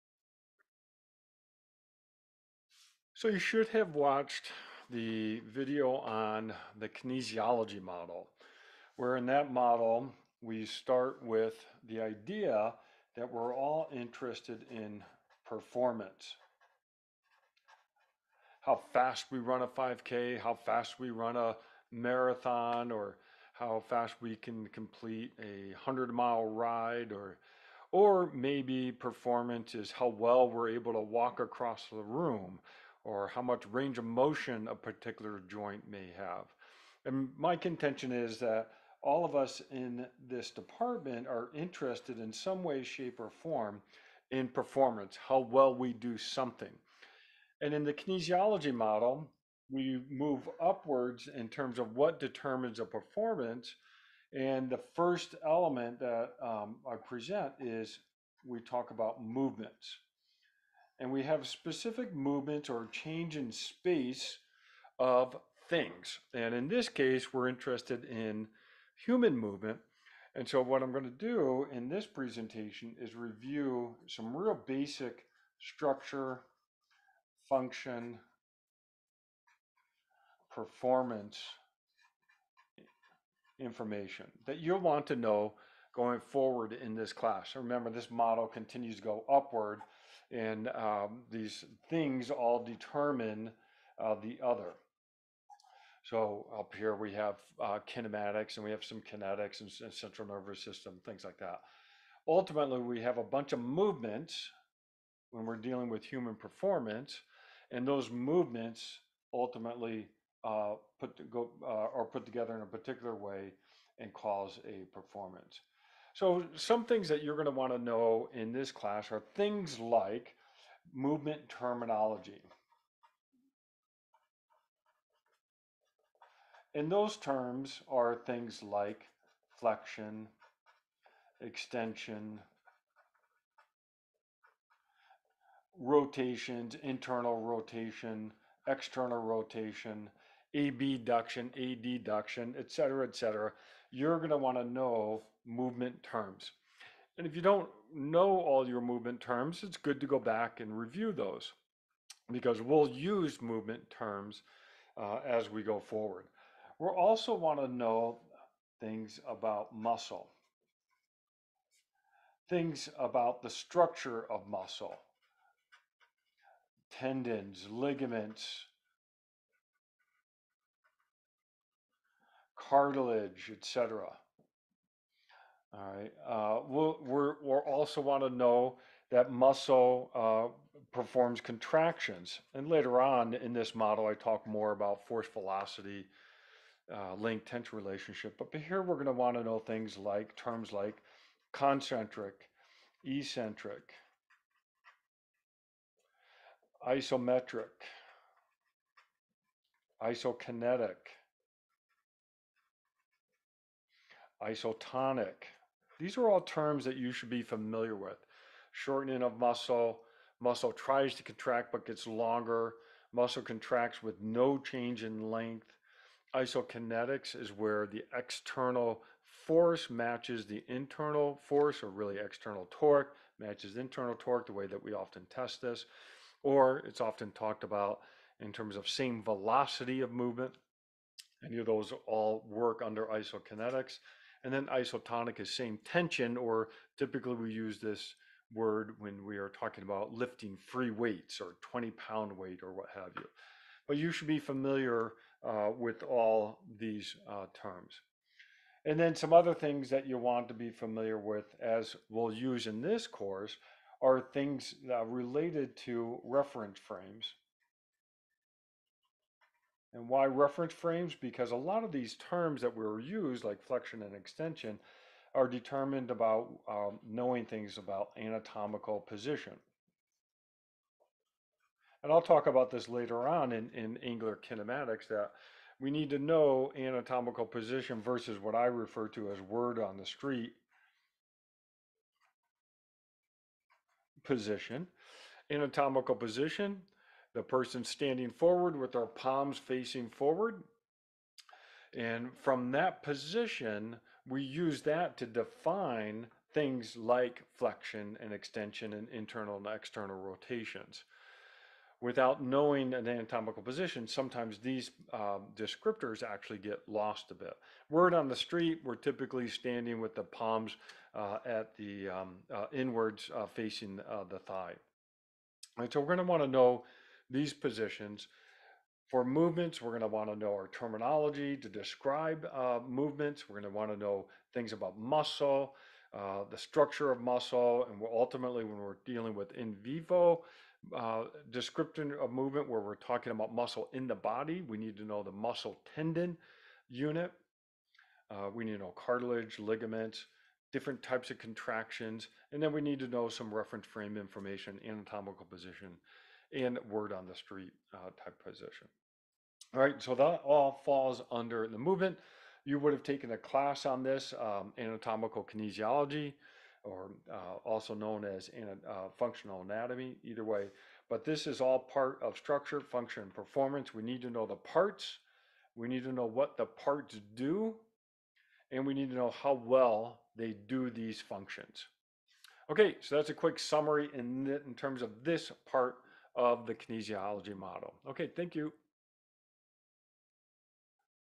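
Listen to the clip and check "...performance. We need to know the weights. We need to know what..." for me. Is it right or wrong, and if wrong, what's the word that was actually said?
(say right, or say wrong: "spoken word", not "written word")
wrong: "parts", not "weights".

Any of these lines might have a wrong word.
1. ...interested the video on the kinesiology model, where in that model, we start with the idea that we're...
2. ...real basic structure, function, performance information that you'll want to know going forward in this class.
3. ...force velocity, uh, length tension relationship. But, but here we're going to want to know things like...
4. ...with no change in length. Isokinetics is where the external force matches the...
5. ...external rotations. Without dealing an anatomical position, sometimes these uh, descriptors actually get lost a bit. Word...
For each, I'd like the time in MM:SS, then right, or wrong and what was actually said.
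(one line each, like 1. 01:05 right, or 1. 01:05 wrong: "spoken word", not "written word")
1. 00:03 wrong: "watched", not "interested"
2. 01:14 right
3. 03:05 right
4. 03:34 right
5. 04:59 wrong: "knowing", not "dealing".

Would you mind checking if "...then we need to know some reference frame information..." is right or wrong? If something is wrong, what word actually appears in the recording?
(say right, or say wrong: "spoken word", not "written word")
right.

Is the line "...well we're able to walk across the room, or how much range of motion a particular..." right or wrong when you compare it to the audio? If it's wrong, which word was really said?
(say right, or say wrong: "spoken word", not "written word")
right.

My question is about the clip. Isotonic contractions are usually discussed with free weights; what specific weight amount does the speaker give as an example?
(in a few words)
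20 pounds.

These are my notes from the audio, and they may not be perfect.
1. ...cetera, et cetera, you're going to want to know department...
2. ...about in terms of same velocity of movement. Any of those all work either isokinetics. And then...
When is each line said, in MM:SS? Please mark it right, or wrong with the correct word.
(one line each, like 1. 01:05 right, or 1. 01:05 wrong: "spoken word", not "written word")
1. 02:22 wrong: "movement", not "department"
2. 03:47 wrong: "under", not "either".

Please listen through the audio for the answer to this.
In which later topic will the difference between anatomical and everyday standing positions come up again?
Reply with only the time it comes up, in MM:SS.
04:33.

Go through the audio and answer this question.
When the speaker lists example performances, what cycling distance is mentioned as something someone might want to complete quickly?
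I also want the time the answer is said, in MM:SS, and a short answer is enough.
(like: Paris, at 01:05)
100 miles, at 00:25.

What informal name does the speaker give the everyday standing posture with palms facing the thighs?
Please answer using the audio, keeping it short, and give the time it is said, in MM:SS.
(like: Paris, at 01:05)
Word on the street position, at 04:39.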